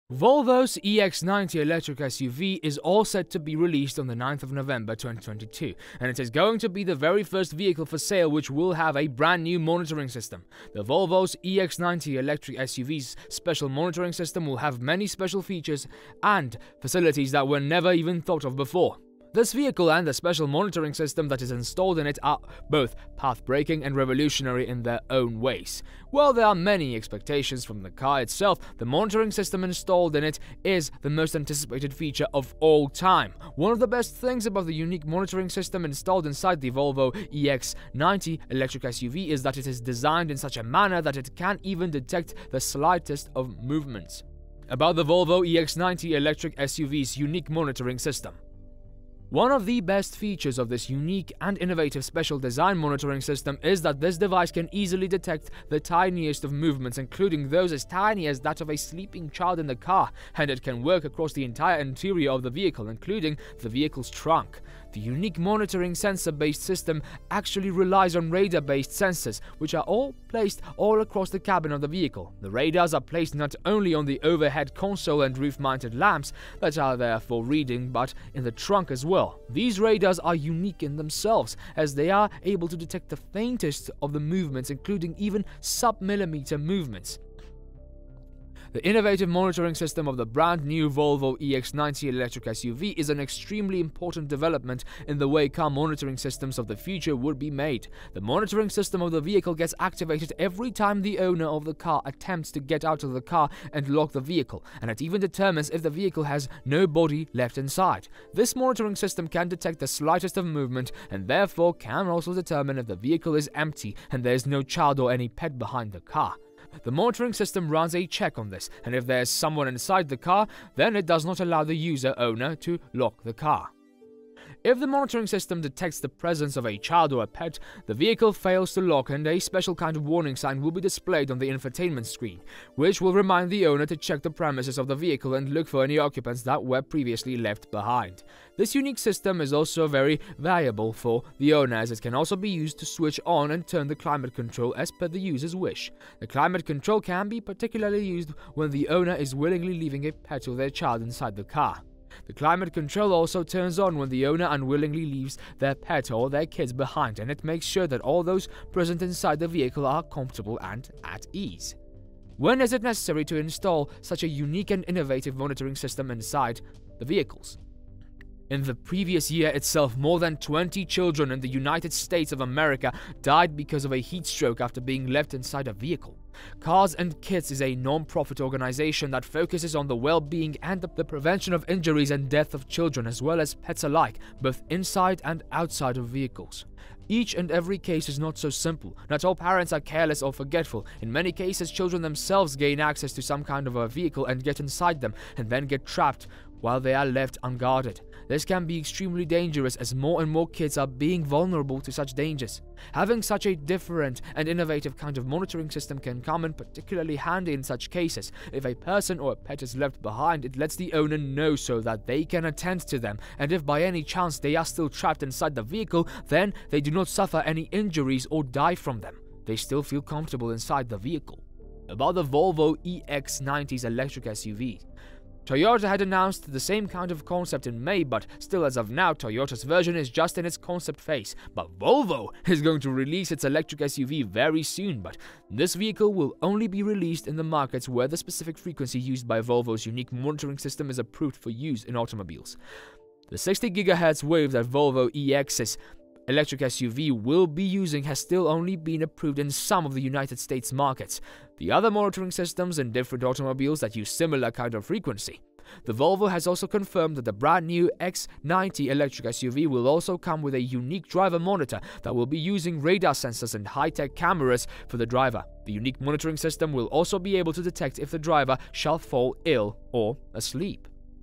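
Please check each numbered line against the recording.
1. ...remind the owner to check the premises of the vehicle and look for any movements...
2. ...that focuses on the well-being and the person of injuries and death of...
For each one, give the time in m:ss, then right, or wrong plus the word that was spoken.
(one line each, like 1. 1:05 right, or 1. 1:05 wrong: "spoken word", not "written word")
1. 2:13 wrong: "occupants", not "movements"
2. 2:59 wrong: "prevention", not "person".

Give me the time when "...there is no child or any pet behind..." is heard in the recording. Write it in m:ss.
1:54.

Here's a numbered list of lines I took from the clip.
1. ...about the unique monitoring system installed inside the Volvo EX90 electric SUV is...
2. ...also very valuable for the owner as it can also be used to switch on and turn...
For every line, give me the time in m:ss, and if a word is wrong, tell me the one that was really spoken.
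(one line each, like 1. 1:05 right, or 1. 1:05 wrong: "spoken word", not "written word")
1. 0:34 right
2. 2:19 right.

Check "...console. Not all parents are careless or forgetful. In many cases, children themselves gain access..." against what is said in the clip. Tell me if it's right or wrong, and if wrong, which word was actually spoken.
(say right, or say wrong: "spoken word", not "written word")
wrong: "simple", not "console".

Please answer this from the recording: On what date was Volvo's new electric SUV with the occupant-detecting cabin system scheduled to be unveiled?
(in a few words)
9 November 2022.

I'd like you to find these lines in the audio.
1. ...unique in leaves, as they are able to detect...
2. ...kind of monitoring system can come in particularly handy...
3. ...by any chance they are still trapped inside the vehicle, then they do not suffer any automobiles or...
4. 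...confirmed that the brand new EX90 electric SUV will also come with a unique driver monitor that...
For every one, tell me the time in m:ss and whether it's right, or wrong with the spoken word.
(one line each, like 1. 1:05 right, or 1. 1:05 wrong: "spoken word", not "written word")
1. 1:20 wrong: "themselves", not "leaves"
2. 3:24 right
3. 3:33 wrong: "injuries", not "automobiles"
4. 4:16 right.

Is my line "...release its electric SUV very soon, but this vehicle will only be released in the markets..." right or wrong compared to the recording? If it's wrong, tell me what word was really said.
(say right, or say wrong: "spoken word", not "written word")
right.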